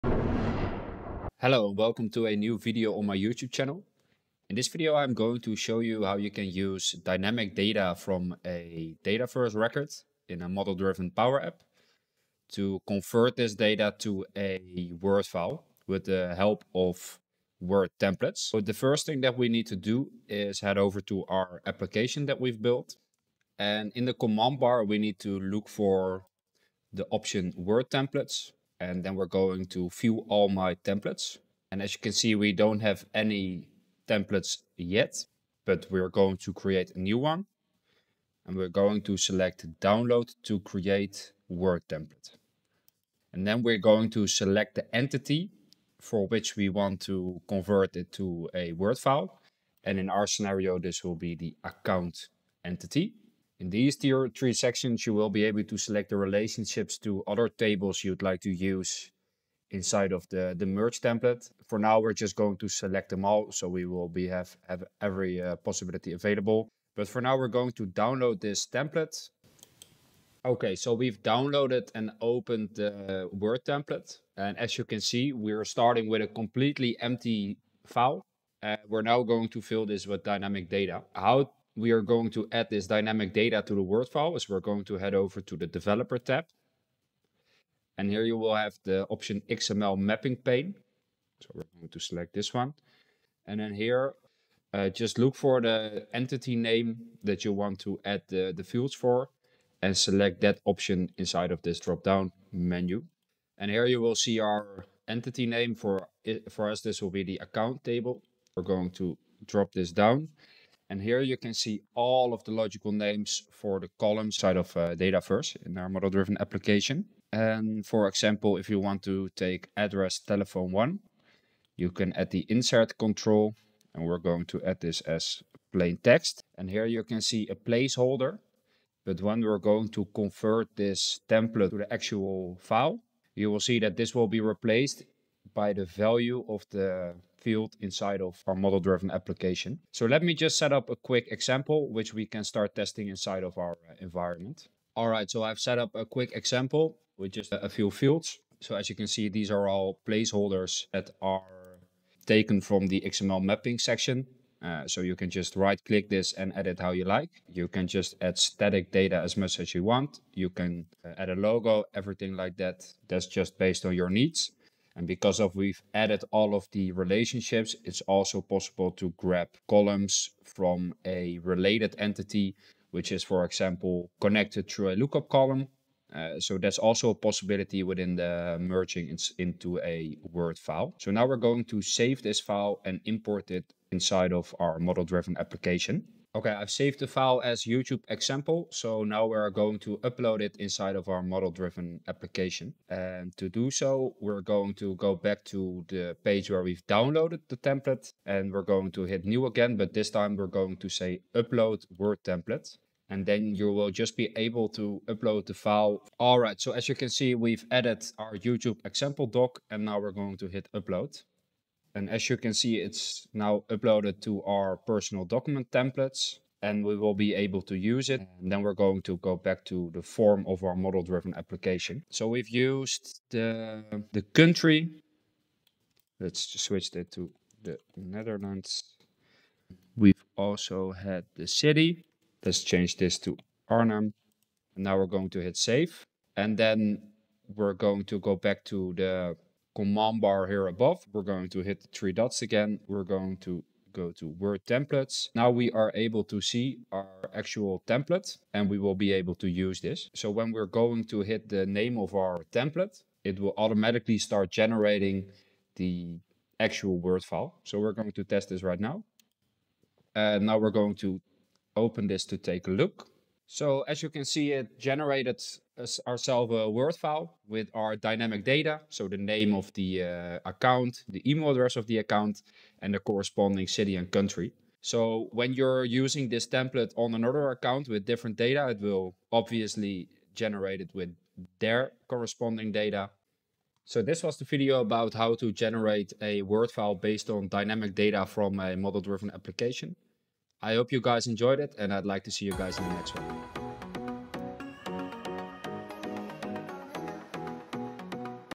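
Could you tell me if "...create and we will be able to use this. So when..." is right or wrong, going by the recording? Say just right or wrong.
wrong.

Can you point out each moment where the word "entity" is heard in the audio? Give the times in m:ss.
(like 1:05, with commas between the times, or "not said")
0:44, 0:52, 1:36, 1:45, 2:51.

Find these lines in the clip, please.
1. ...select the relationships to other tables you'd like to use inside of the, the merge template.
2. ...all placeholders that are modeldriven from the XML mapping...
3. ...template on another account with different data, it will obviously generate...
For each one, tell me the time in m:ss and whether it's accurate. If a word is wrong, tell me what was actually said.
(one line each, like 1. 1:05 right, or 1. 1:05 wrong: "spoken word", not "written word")
1. 0:55 right
2. 2:29 wrong: "taken", not "modeldriven"
3. 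4:36 right.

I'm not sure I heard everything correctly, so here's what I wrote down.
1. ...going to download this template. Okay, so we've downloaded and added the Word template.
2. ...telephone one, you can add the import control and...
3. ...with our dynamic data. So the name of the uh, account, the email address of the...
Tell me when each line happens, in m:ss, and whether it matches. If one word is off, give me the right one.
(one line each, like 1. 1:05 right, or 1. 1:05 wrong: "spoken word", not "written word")
1. 1:07 wrong: "opened", not "added"
2. 2:00 wrong: "insert", not "import"
3. 4:27 right.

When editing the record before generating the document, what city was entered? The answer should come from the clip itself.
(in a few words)
Arnhem.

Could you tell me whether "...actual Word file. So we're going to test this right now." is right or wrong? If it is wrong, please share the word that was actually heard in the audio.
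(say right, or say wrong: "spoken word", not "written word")
right.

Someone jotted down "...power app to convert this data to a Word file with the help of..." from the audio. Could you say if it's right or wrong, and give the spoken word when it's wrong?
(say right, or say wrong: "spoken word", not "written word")
right.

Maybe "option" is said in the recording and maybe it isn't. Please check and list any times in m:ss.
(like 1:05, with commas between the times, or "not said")
0:27, 1:29, 1:40.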